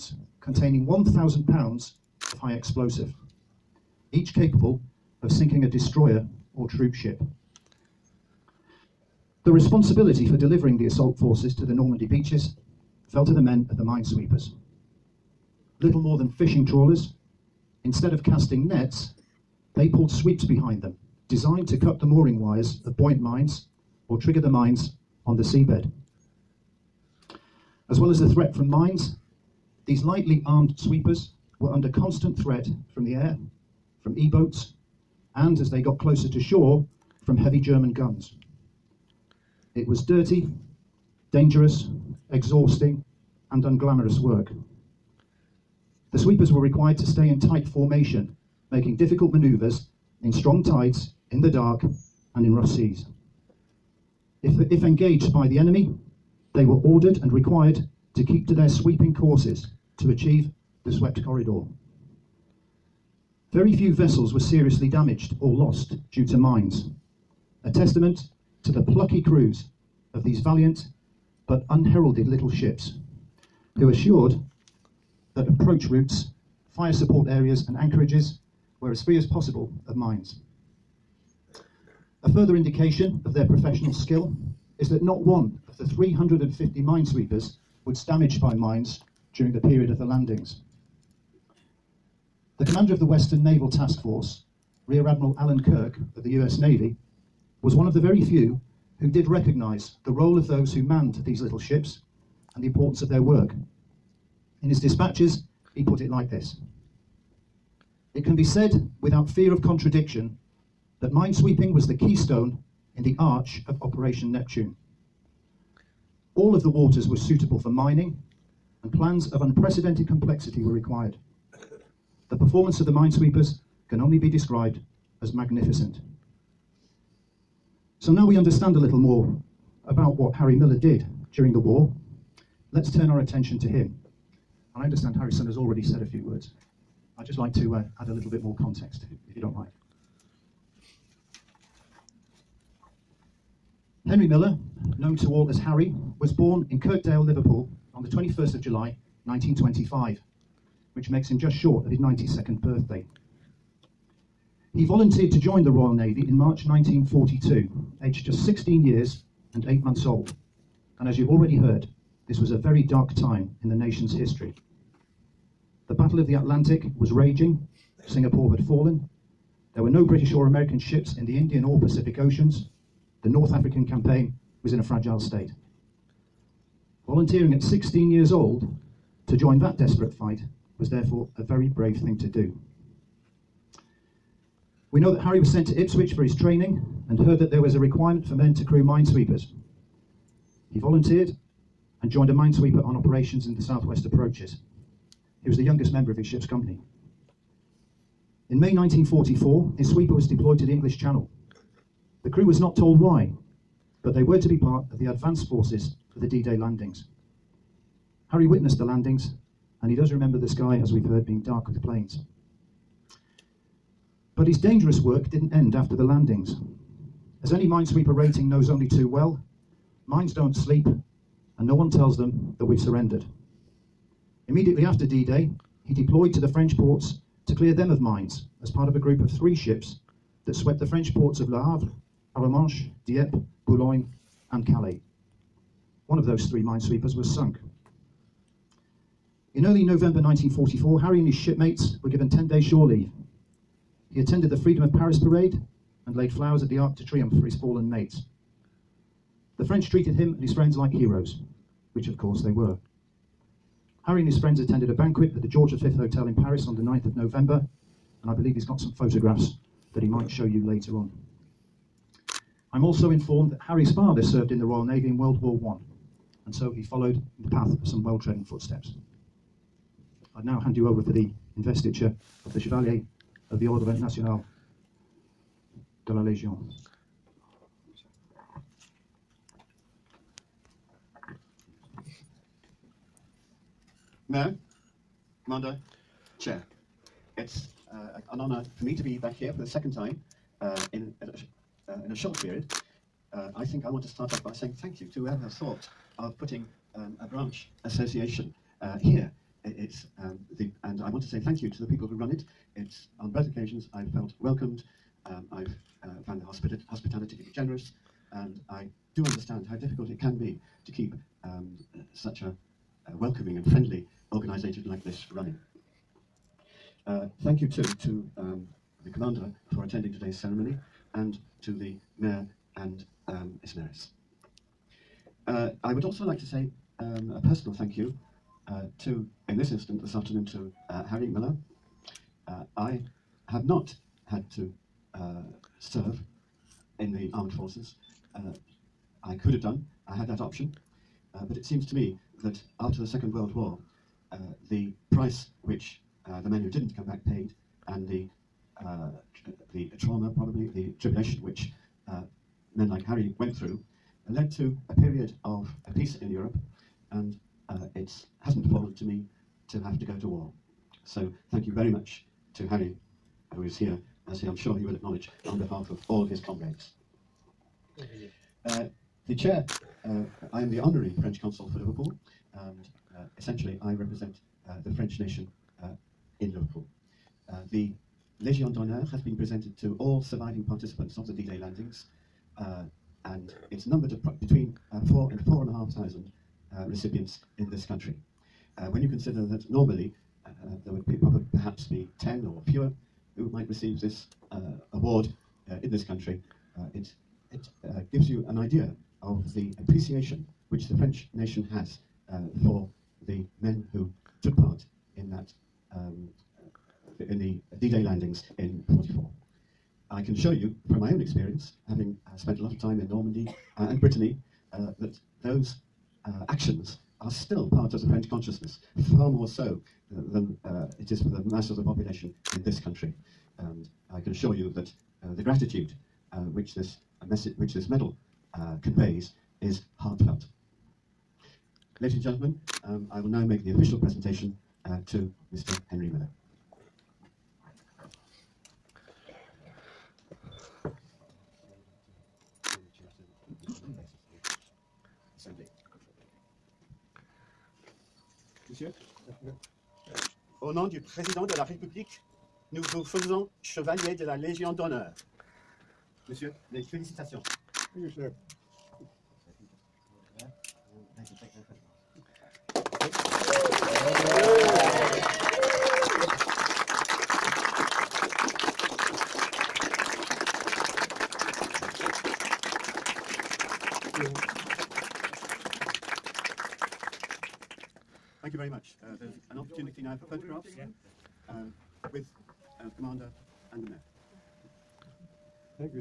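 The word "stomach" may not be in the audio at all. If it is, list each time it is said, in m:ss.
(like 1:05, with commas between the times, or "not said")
not said.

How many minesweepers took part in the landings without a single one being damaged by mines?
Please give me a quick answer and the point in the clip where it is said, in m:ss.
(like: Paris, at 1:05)
350, at 1:25.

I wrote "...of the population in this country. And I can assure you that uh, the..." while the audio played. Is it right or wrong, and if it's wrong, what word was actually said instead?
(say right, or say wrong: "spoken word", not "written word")
right.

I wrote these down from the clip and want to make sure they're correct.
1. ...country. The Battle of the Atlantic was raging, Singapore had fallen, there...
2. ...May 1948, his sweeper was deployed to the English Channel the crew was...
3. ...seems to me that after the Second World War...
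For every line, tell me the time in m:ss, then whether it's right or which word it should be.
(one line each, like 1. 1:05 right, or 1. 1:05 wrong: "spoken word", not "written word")
1. 2:44 wrong: "history", not "country"
2. 3:18 wrong: "1944", not "1948"
3. 5:41 right.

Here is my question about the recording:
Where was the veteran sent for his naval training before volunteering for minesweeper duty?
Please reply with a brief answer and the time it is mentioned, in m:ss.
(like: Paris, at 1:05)
Ipswich, at 3:05.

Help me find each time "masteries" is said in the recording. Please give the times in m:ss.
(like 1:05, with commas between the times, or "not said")
not said.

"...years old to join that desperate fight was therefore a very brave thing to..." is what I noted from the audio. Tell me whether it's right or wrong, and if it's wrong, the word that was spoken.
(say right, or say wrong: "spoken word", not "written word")
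right.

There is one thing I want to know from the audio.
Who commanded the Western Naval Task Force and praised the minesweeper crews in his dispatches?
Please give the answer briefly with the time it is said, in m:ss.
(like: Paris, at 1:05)
Alan Kirk, at 1:35.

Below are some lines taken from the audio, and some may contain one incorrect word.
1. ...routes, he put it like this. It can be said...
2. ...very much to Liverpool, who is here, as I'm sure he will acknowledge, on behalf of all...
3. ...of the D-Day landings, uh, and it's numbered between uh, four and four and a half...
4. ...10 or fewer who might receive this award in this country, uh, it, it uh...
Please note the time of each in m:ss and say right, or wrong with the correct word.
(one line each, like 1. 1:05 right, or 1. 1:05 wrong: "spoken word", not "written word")
1. 1:44 wrong: "dispatches", not "routes"
2. 6:01 wrong: "Harry", not "Liverpool"
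3. 6:21 right
4. 6:32 right.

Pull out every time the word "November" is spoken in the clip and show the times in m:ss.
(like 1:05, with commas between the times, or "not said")
3:59, 4:17.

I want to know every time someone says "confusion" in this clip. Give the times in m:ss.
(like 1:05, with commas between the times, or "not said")
not said.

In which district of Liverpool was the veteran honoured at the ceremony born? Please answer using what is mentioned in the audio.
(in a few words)
Kirkdale.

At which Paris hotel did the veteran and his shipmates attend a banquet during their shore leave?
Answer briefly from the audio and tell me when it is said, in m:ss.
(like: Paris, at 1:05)
George V Hotel, at 4:15.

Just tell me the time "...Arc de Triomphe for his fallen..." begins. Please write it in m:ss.
4:06.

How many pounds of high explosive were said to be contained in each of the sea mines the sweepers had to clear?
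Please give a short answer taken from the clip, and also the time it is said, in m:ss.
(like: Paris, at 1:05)
1,000, at 0:00.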